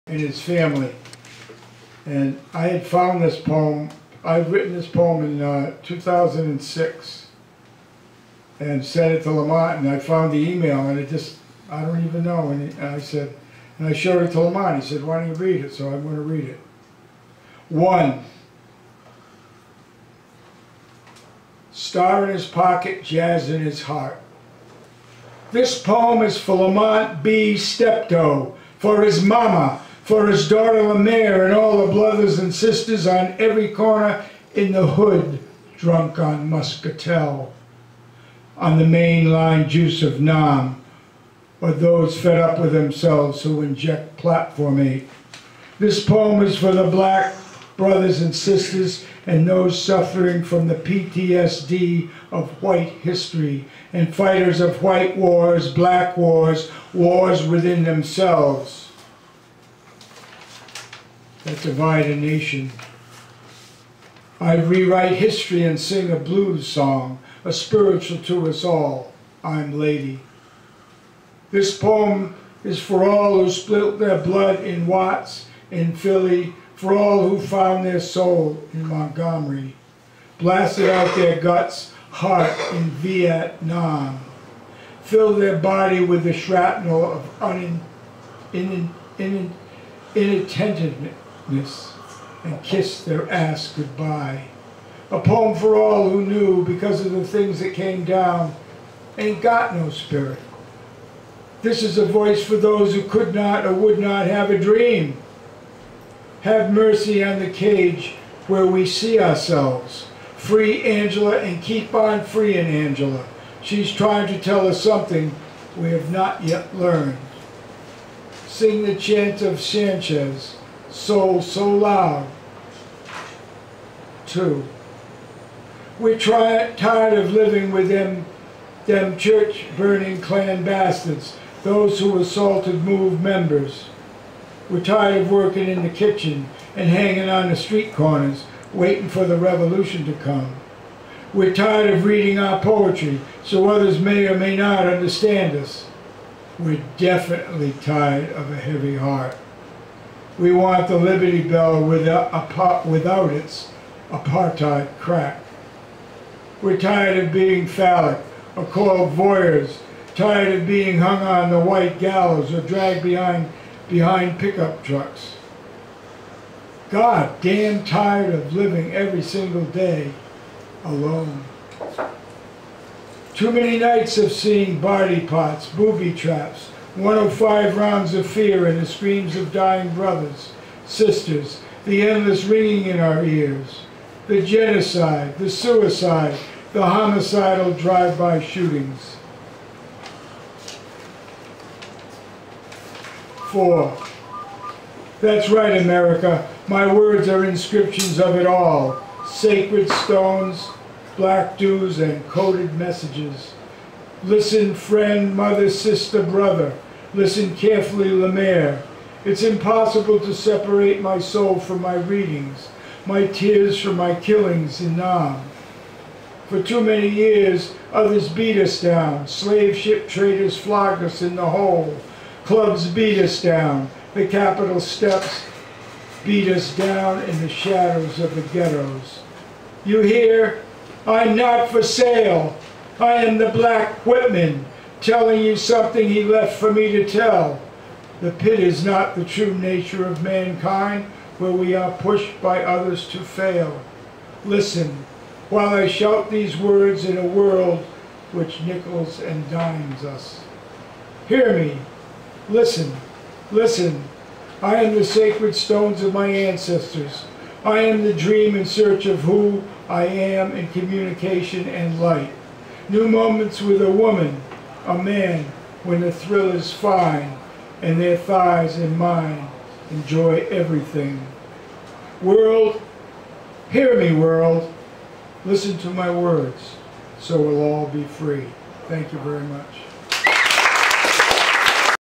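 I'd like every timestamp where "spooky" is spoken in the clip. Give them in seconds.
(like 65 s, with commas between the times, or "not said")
not said.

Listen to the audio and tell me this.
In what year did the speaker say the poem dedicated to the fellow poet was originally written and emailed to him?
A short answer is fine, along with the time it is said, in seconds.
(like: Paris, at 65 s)
2006, at 5 s.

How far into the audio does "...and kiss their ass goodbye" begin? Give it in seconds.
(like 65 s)
92 s.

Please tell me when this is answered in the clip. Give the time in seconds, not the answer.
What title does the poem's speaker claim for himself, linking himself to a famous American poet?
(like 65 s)
233 s.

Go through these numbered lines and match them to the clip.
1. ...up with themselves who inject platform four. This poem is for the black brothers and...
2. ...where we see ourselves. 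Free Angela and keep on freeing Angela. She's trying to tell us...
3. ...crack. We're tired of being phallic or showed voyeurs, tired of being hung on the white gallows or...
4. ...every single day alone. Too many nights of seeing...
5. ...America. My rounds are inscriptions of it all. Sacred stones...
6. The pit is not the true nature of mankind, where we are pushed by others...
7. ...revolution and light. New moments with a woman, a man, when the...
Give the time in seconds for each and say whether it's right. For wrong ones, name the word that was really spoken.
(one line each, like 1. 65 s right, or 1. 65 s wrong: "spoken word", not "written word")
1. 42 s wrong: "eight", not "four"
2. 108 s right
3. 154 s wrong: "called", not "showed"
4. 168 s right
5. 195 s wrong: "words", not "rounds"
6. 238 s right
7. 260 s wrong: "communication", not "revolution".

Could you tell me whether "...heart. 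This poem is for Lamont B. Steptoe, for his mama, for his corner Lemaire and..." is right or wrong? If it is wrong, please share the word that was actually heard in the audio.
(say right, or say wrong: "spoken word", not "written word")
wrong: "daughter", not "corner".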